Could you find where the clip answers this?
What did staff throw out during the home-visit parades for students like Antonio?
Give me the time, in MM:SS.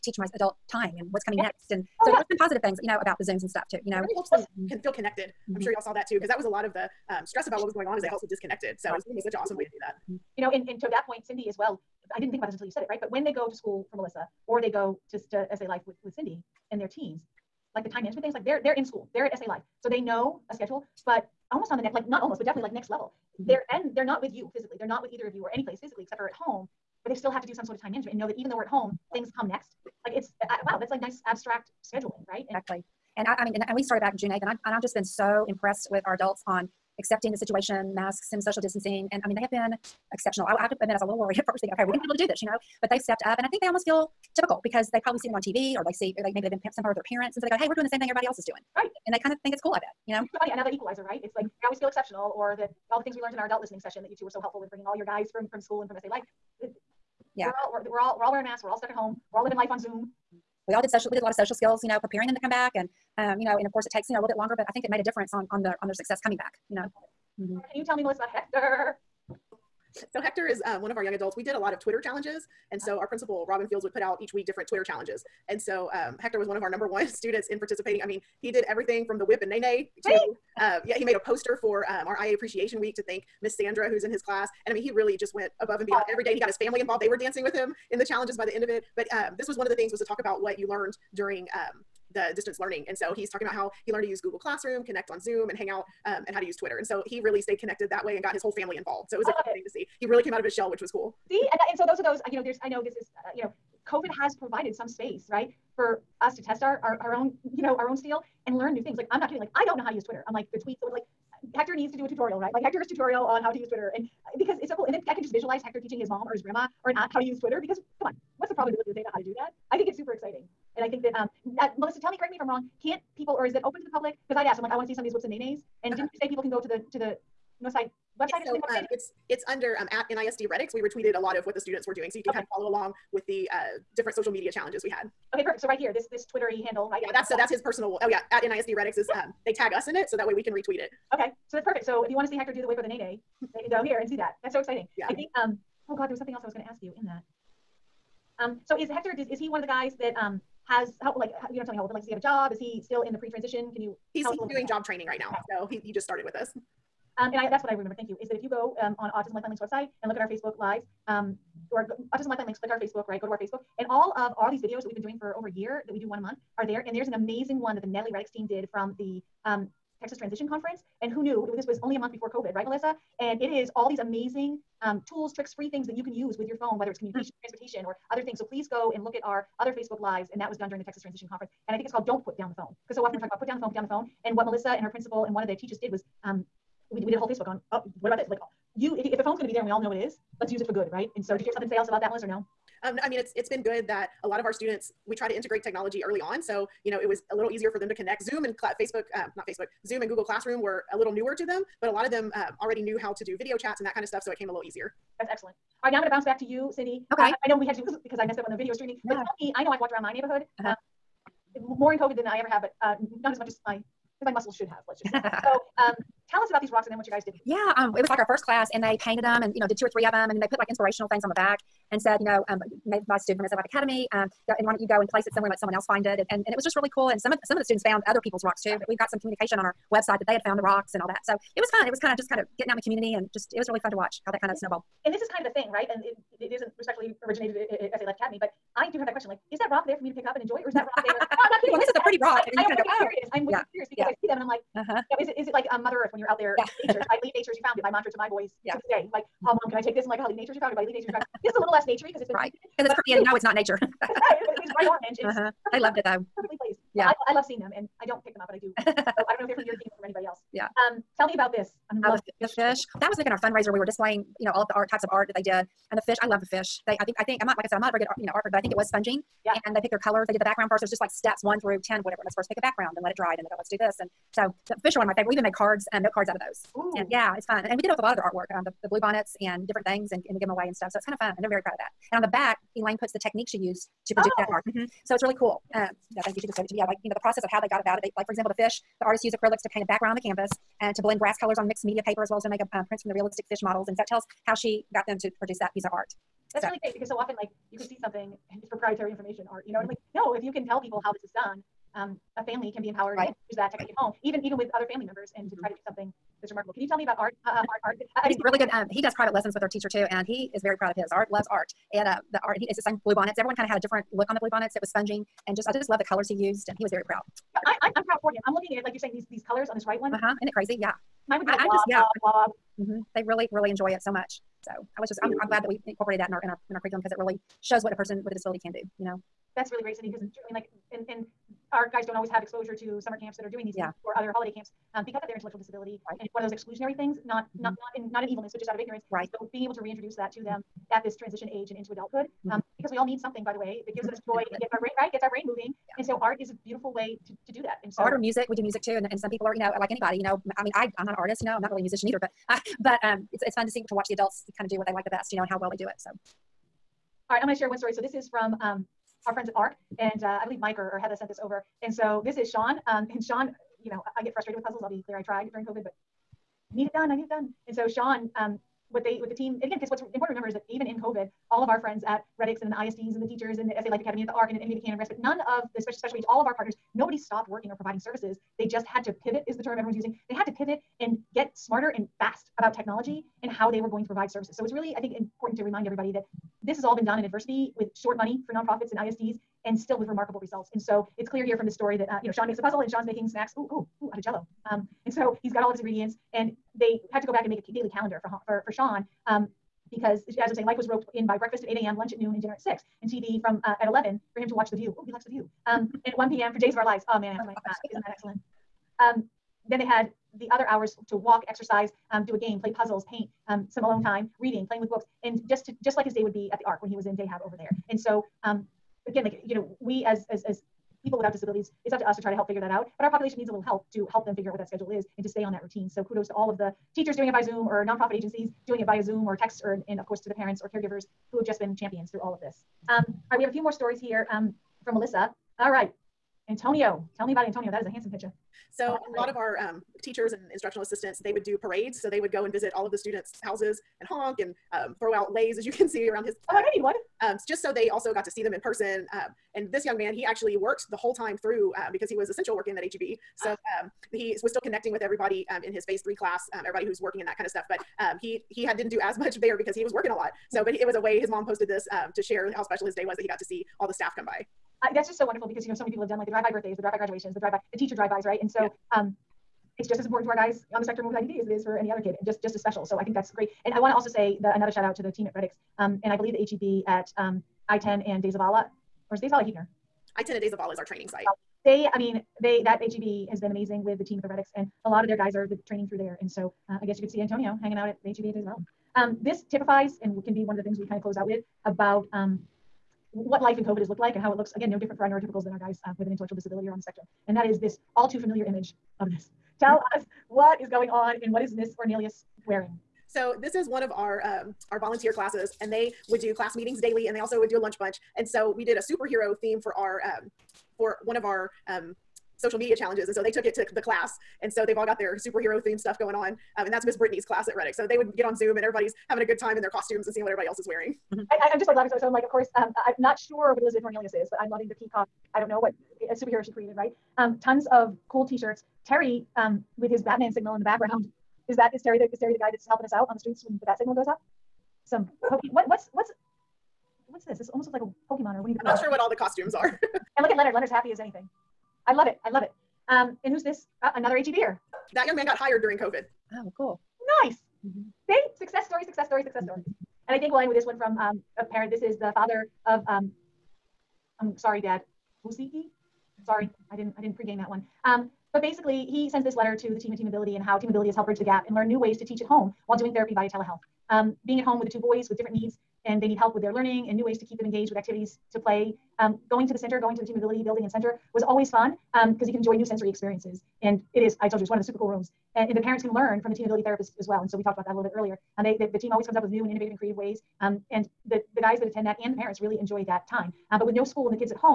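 07:25.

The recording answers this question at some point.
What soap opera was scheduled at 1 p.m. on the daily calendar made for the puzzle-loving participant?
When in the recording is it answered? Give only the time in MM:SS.
06:46.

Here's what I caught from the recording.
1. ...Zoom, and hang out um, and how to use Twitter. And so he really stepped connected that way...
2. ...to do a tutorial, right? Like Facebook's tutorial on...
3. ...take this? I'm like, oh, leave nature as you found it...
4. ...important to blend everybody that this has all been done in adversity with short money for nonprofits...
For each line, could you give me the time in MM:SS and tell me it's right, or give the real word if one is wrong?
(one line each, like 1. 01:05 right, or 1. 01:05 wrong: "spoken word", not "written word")
1. 01:35 wrong: "stayed", not "stepped"
2. 01:51 wrong: "Hector", not "Facebook"
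3. 04:09 right
4. 06:25 wrong: "remind", not "blend".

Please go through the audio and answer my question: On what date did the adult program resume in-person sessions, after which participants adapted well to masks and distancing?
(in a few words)
June 8th.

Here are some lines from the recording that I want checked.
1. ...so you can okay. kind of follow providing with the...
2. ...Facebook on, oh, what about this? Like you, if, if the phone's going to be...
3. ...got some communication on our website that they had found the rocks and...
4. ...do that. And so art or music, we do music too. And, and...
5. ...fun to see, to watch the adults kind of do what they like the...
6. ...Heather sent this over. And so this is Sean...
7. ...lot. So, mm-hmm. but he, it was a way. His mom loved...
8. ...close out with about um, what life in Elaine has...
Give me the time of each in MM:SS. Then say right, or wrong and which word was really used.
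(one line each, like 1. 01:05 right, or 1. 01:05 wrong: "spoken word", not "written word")
1. 02:12 wrong: "along", not "providing"
2. 03:07 right
3. 03:48 right
4. 05:47 right
5. 05:53 right
6. 06:01 right
7. 07:40 wrong: "posted", not "loved"
8. 08:11 wrong: "COVID", not "Elaine".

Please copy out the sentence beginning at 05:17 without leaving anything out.
Yeah, I, I'm, I'm proud for him.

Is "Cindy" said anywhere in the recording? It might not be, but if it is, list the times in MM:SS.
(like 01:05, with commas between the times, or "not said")
00:11, 00:16, 03:26, 05:29.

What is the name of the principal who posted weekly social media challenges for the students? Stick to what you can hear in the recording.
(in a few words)
Robin Fields.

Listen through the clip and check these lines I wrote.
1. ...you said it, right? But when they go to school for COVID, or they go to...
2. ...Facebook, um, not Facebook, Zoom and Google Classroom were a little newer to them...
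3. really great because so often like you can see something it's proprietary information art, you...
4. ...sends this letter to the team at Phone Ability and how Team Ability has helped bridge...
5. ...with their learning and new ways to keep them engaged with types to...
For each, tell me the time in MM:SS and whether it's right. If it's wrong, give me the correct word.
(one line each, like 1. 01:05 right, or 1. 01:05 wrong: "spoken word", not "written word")
1. 00:12 wrong: "Melissa", not "COVID"
2. 03:18 right
3. 04:56 right
4. 09:19 wrong: "Team", not "Phone"
5. 09:26 wrong: "activities", not "types".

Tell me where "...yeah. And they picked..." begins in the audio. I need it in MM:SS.
04:29.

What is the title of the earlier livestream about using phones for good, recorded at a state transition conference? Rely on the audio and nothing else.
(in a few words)
Don't Put Down the Phone.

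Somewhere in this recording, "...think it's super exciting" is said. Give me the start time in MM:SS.
01:59.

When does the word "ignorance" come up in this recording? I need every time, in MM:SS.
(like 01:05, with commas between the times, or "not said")
05:38.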